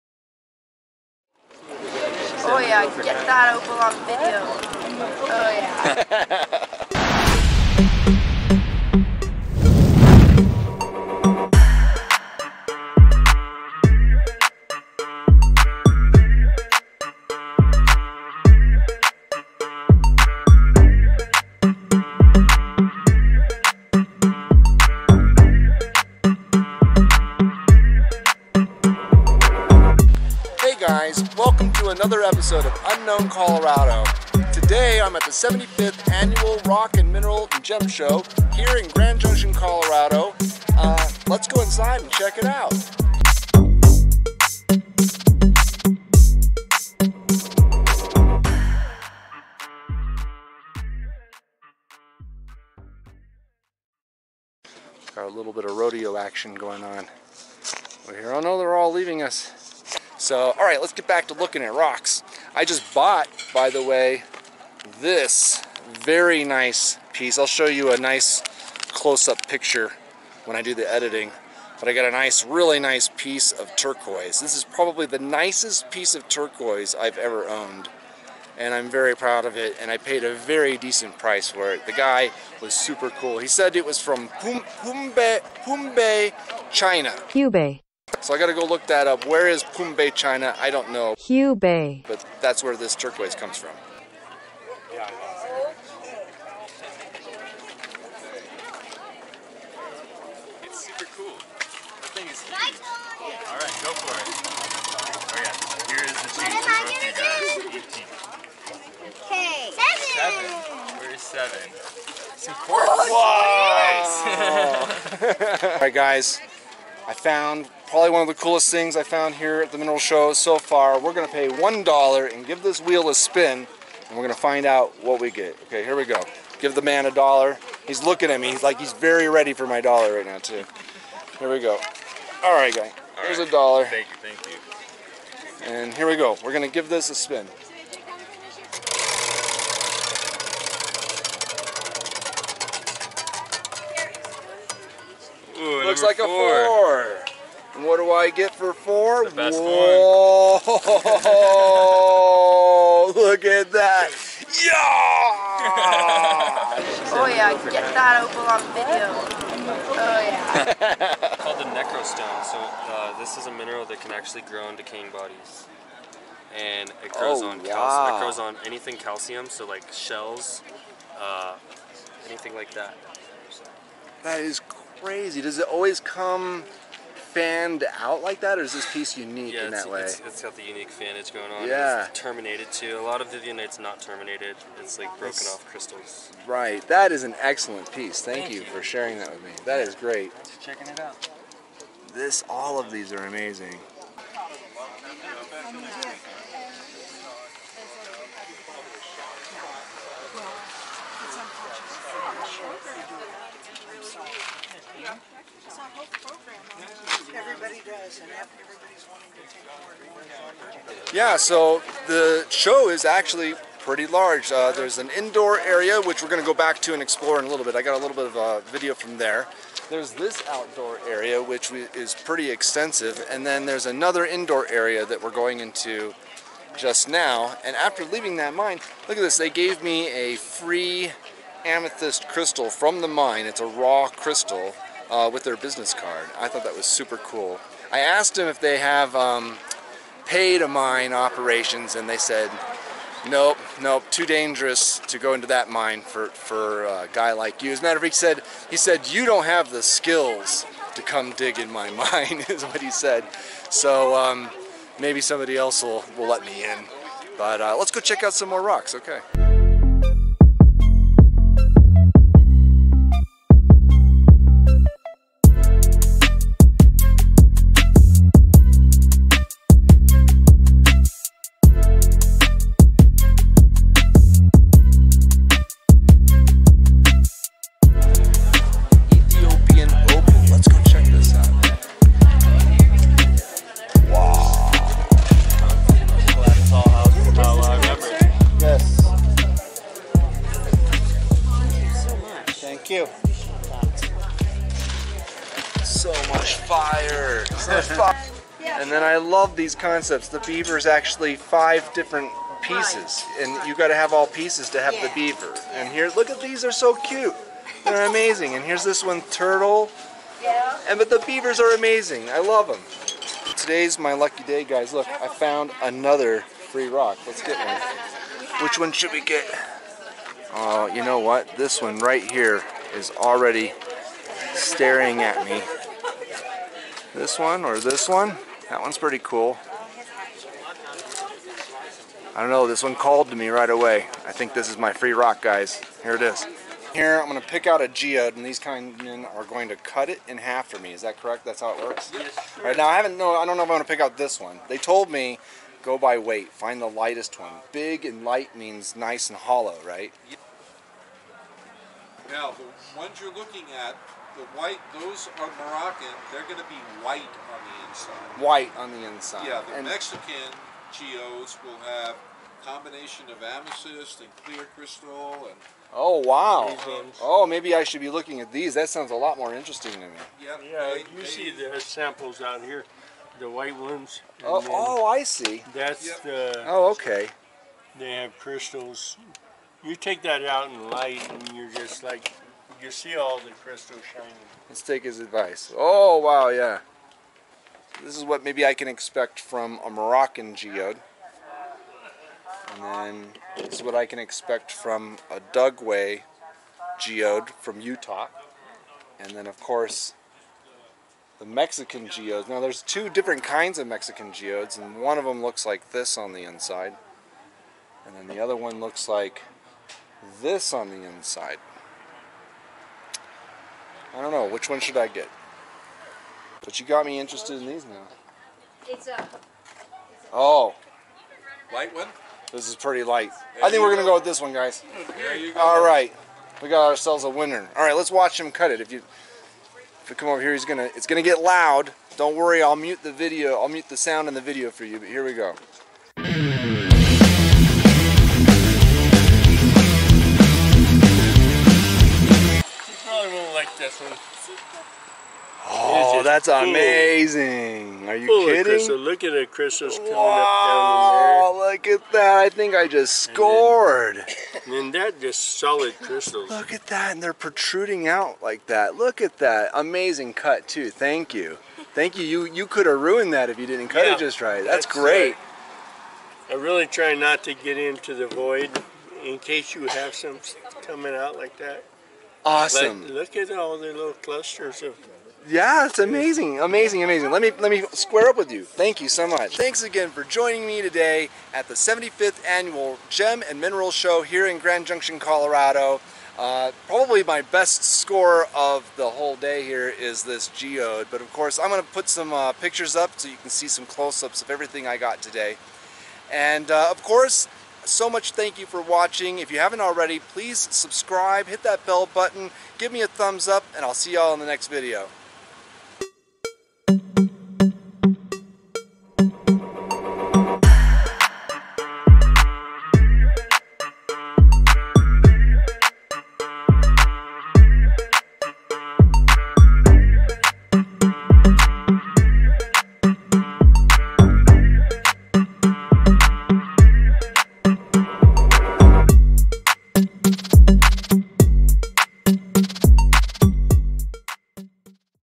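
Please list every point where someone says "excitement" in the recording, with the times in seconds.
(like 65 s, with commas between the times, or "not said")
not said.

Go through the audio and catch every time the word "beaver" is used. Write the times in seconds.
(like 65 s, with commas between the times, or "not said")
300 s, 305 s, 311 s.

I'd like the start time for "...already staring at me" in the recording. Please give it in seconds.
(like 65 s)
323 s.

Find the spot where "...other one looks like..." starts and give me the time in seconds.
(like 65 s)
408 s.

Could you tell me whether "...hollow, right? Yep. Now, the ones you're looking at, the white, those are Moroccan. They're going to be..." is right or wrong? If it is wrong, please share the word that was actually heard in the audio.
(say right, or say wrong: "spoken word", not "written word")
right.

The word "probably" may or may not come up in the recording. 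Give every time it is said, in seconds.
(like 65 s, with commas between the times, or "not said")
74 s, 117 s, 486 s.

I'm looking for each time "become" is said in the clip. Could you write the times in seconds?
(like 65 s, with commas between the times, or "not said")
not said.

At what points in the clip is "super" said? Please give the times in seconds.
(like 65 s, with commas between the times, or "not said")
82 s, 236 s.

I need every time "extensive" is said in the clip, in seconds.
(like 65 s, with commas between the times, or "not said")
222 s.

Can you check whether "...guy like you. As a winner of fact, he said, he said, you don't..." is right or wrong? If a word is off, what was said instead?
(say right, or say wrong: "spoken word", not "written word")
wrong: "matter", not "winner".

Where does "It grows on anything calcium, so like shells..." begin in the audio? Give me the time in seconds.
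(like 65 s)
168 s.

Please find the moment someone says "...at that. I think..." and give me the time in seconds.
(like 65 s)
451 s.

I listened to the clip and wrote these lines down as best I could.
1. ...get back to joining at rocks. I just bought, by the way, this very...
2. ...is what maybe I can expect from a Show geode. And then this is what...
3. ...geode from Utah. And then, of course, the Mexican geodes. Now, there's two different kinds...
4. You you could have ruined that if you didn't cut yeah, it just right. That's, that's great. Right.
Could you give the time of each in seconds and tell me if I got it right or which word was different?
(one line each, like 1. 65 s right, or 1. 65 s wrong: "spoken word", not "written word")
1. 60 s wrong: "looking", not "joining"
2. 388 s wrong: "Moroccan", not "Show"
3. 396 s right
4. 462 s right.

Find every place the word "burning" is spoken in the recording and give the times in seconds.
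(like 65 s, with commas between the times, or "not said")
not said.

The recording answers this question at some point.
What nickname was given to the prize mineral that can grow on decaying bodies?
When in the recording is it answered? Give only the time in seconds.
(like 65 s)
161 s.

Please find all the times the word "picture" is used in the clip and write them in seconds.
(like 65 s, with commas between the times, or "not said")
69 s, 492 s.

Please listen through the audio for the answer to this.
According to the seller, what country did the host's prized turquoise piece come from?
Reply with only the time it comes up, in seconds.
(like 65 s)
86 s.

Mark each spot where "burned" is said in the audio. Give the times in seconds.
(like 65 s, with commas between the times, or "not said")
not said.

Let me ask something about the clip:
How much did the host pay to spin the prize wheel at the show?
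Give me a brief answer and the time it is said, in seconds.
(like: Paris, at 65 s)
$1, at 121 s.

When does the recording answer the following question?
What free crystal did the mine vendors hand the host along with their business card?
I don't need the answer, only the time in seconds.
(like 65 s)
231 s.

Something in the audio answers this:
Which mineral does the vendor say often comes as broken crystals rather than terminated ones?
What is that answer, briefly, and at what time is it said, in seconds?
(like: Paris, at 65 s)
Vivianite, at 183 s.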